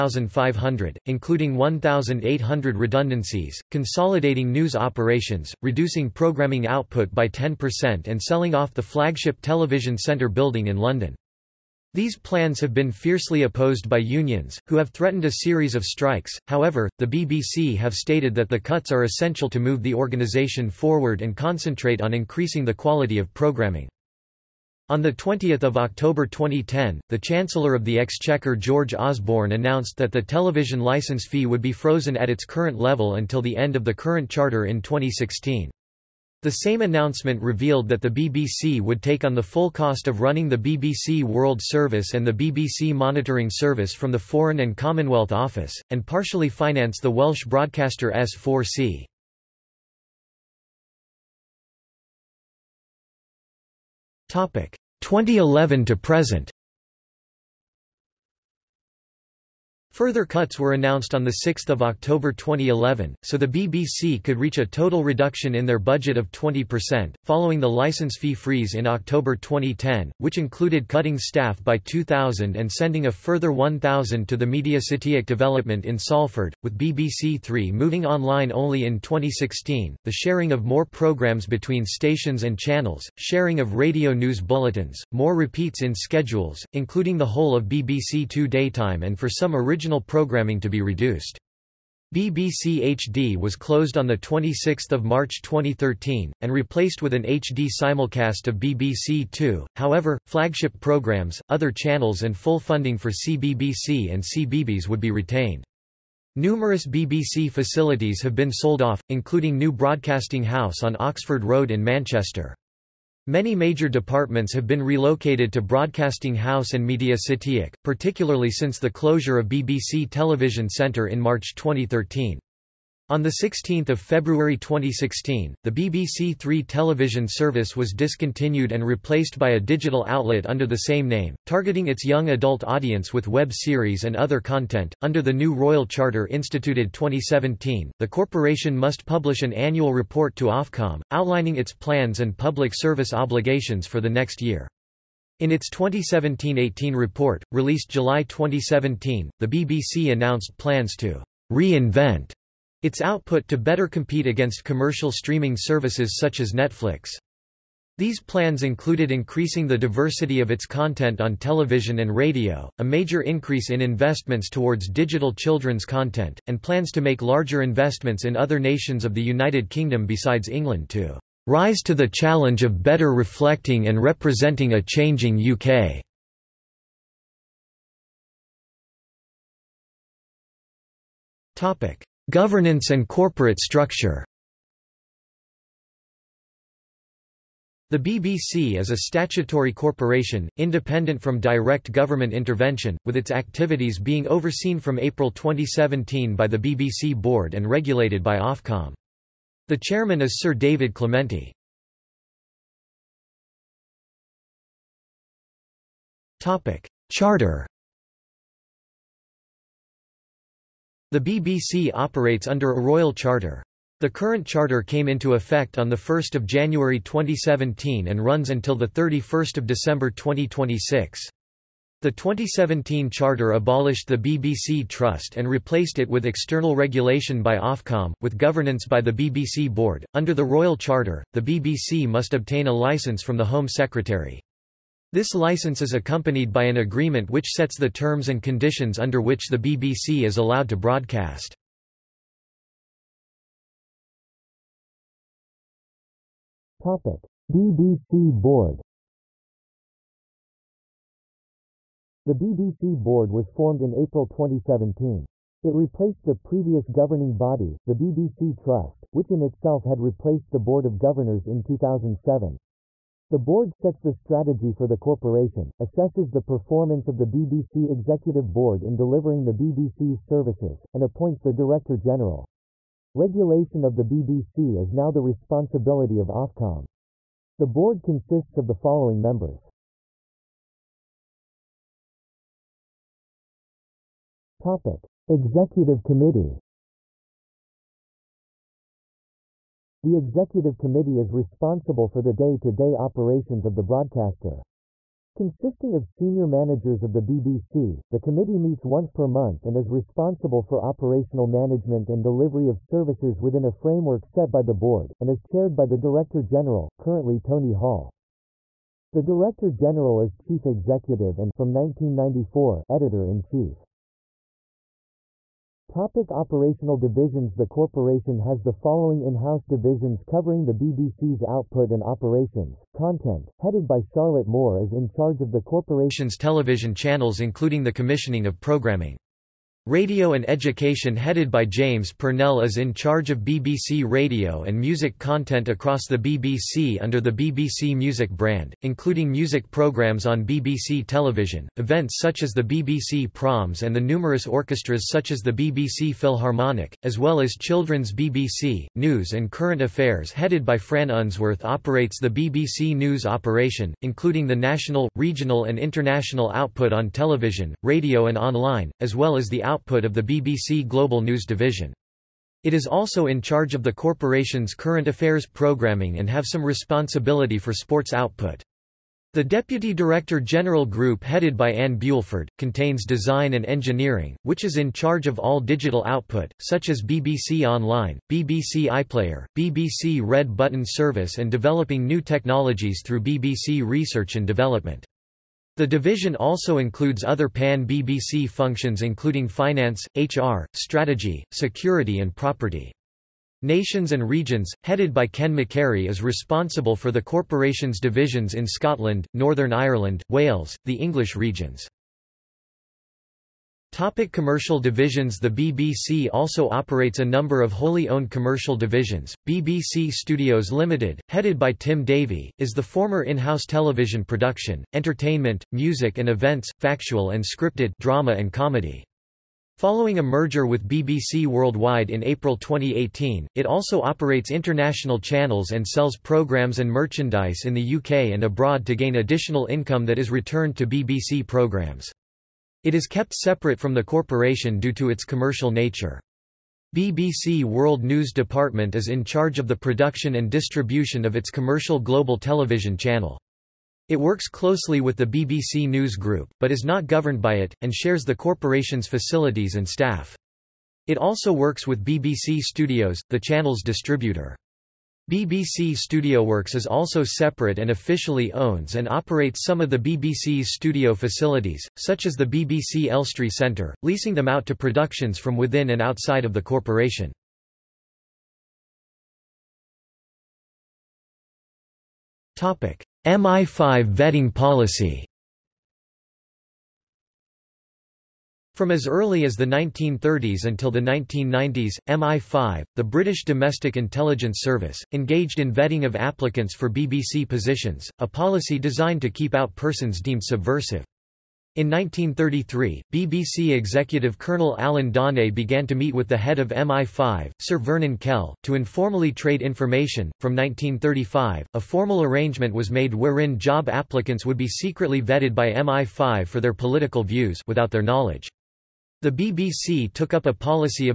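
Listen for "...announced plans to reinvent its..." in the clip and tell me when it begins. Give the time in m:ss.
2:30.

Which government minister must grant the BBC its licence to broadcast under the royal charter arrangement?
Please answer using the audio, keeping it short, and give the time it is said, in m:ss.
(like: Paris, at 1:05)
Home Secretary, at 3:53.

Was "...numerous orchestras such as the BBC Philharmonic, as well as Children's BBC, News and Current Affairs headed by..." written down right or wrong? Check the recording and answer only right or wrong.
right.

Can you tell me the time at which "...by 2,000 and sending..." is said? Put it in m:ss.
1:11.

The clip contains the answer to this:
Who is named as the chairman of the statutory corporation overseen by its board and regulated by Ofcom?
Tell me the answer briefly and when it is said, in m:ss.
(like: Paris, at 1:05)
Sir David Clementi, at 3:20.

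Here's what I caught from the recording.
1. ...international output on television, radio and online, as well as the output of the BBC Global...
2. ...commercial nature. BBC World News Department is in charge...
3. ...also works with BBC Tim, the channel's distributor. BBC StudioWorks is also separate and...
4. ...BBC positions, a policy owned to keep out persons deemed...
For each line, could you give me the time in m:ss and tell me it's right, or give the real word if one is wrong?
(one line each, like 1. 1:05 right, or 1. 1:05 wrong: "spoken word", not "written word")
1. 5:55 right
2. 7:15 right
3. 7:31 wrong: "Studios", not "Tim"
4. 8:06 wrong: "designed", not "owned".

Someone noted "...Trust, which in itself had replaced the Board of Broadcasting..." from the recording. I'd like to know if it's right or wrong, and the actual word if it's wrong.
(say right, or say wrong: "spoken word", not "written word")
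wrong: "Governors", not "Broadcasting".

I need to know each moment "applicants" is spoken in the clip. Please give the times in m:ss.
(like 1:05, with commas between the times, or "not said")
8:06, 8:23.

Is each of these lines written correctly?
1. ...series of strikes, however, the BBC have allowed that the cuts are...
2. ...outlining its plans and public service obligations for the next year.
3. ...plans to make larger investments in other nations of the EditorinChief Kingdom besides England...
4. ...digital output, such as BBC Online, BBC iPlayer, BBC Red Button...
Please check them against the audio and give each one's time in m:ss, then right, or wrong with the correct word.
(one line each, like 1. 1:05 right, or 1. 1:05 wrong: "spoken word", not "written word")
1. 0:15 wrong: "stated", not "allowed"
2. 2:21 right
3. 2:46 wrong: "United", not "EditorinChief"
4. 6:15 right.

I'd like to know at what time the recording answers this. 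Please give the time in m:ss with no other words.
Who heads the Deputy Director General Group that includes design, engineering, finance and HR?
6:11.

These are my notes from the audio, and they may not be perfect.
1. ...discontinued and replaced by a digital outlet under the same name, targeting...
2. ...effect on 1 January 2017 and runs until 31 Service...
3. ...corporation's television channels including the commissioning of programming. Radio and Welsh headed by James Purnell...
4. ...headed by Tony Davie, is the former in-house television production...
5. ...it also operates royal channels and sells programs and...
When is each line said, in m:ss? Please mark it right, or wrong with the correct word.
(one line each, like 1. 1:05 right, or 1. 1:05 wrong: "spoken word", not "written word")
1. 2:07 right
2. 3:35 wrong: "December", not "Service"
3. 5:25 wrong: "Education", not "Welsh"
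4. 6:51 wrong: "Tim", not "Tony"
5. 7:03 wrong: "international", not "royal".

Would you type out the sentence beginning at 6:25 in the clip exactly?
The division also includes other pan-BBC functions including finance, HR, strategy, security and property.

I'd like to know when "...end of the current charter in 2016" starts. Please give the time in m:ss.
0:33.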